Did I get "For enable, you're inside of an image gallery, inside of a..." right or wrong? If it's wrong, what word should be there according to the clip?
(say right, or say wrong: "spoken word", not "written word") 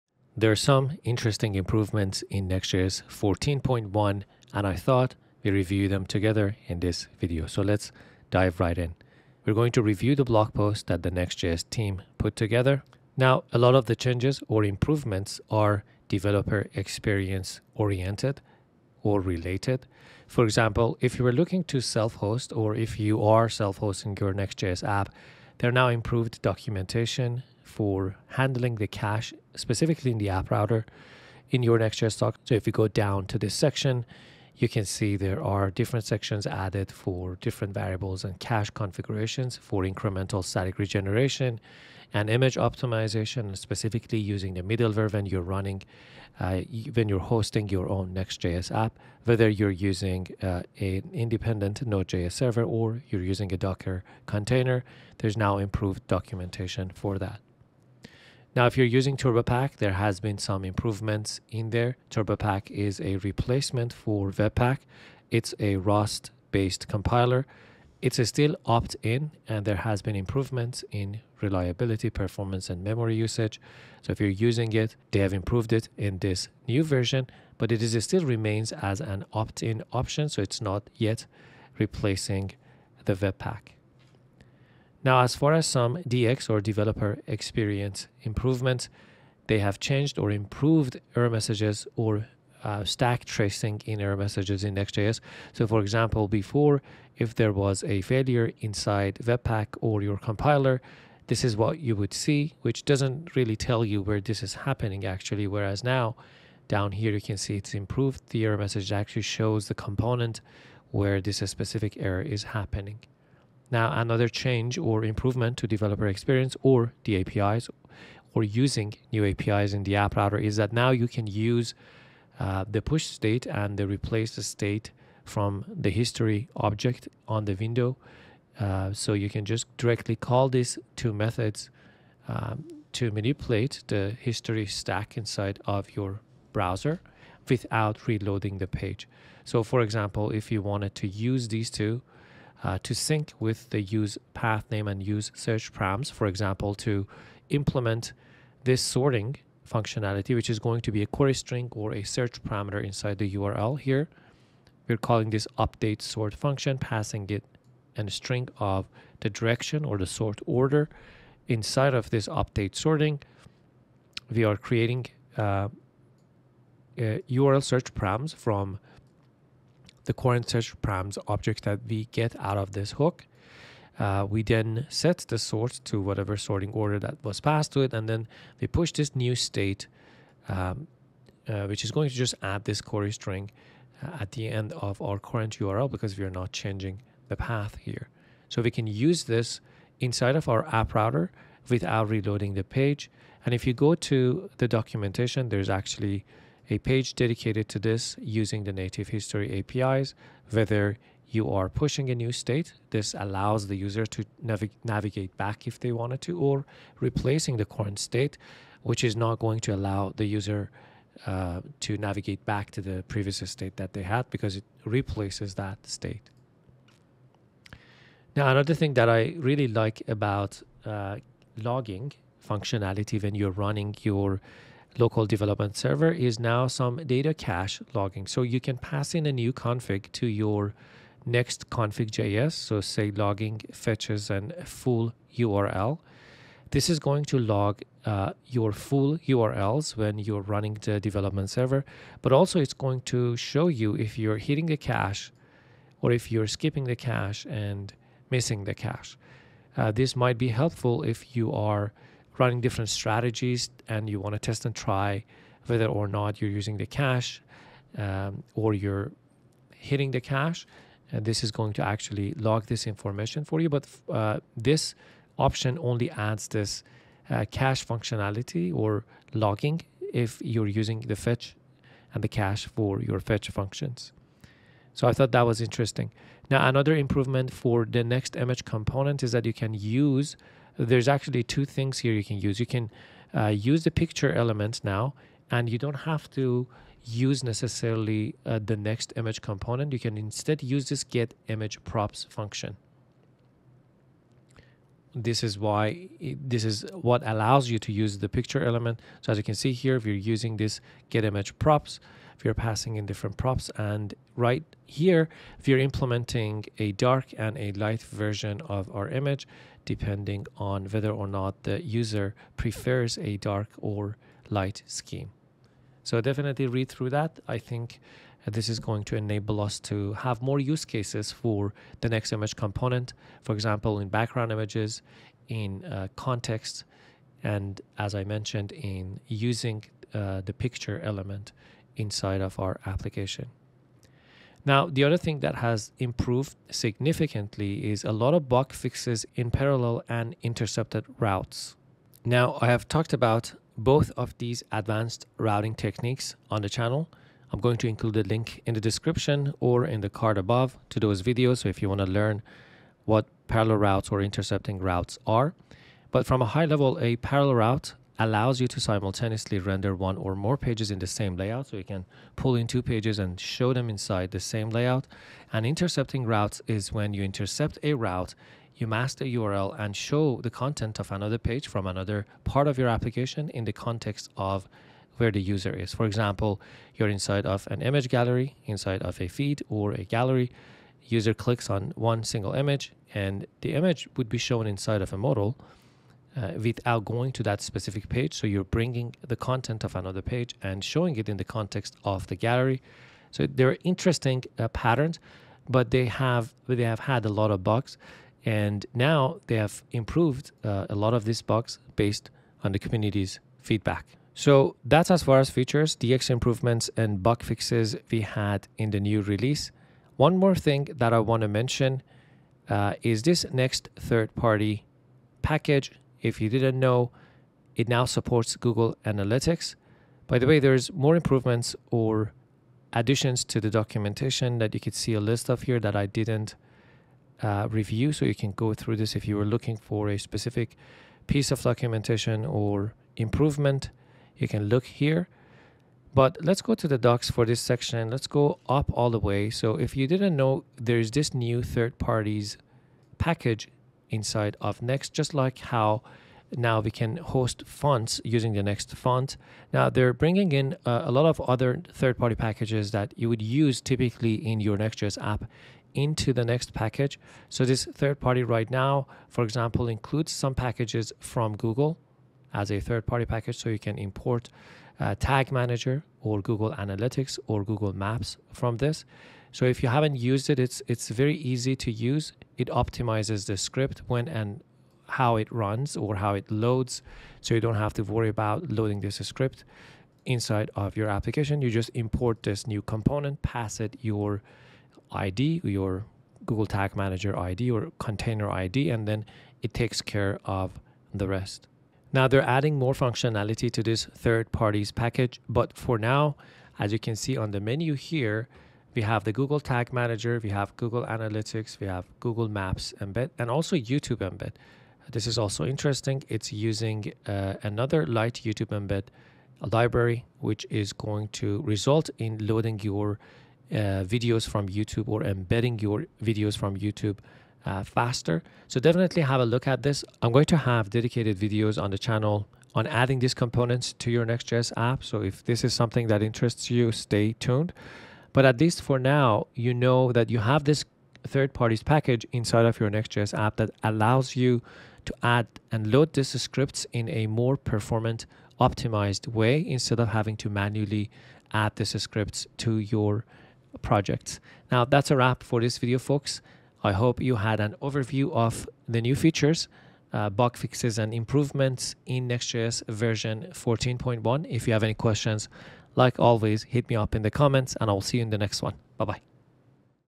wrong: "example", not "enable".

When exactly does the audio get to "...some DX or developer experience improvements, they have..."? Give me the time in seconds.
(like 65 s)
85 s.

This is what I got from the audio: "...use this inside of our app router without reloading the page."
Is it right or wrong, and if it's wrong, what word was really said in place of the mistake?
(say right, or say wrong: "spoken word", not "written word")
right.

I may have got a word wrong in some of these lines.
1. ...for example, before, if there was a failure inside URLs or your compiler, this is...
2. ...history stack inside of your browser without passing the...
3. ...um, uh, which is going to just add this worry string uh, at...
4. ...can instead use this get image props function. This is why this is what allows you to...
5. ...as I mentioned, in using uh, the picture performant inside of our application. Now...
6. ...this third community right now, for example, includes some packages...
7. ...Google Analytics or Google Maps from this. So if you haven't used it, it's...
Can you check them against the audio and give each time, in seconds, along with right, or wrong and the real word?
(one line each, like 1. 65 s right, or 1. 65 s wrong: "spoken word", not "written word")
1. 95 s wrong: "Webpack", not "URLs"
2. 134 s wrong: "reloading", not "passing"
3. 180 s wrong: "query", not "worry"
4. 289 s right
5. 327 s wrong: "element", not "performant"
6. 457 s wrong: "party", not "community"
7. 466 s right.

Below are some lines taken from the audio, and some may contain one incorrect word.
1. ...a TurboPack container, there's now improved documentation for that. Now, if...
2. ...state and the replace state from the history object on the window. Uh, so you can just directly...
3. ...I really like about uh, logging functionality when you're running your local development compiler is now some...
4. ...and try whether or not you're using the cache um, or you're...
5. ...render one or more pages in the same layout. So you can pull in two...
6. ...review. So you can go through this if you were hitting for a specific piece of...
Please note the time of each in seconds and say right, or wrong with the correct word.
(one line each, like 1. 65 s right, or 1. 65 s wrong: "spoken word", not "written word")
1. 53 s wrong: "Docker", not "TurboPack"
2. 123 s right
3. 219 s wrong: "server", not "compiler"
4. 254 s right
5. 359 s right
6. 427 s wrong: "looking", not "hitting".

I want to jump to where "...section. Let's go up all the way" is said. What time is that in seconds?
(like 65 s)
437 s.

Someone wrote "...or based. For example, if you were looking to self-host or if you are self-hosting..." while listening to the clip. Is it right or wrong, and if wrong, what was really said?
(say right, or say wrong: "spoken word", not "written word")
wrong: "related", not "based".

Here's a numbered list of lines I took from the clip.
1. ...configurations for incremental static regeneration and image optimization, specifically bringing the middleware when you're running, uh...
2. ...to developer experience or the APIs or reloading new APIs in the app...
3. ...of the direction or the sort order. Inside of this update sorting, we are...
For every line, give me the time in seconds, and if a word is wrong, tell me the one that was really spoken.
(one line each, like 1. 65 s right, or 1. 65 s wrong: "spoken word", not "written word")
1. 38 s wrong: "using", not "bringing"
2. 115 s wrong: "using", not "reloading"
3. 158 s right.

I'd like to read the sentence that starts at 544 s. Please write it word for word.
Now, that's a wrap for this video, folks.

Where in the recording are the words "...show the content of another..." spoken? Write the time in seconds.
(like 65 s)
369 s.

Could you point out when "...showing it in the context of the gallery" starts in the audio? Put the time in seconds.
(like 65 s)
390 s.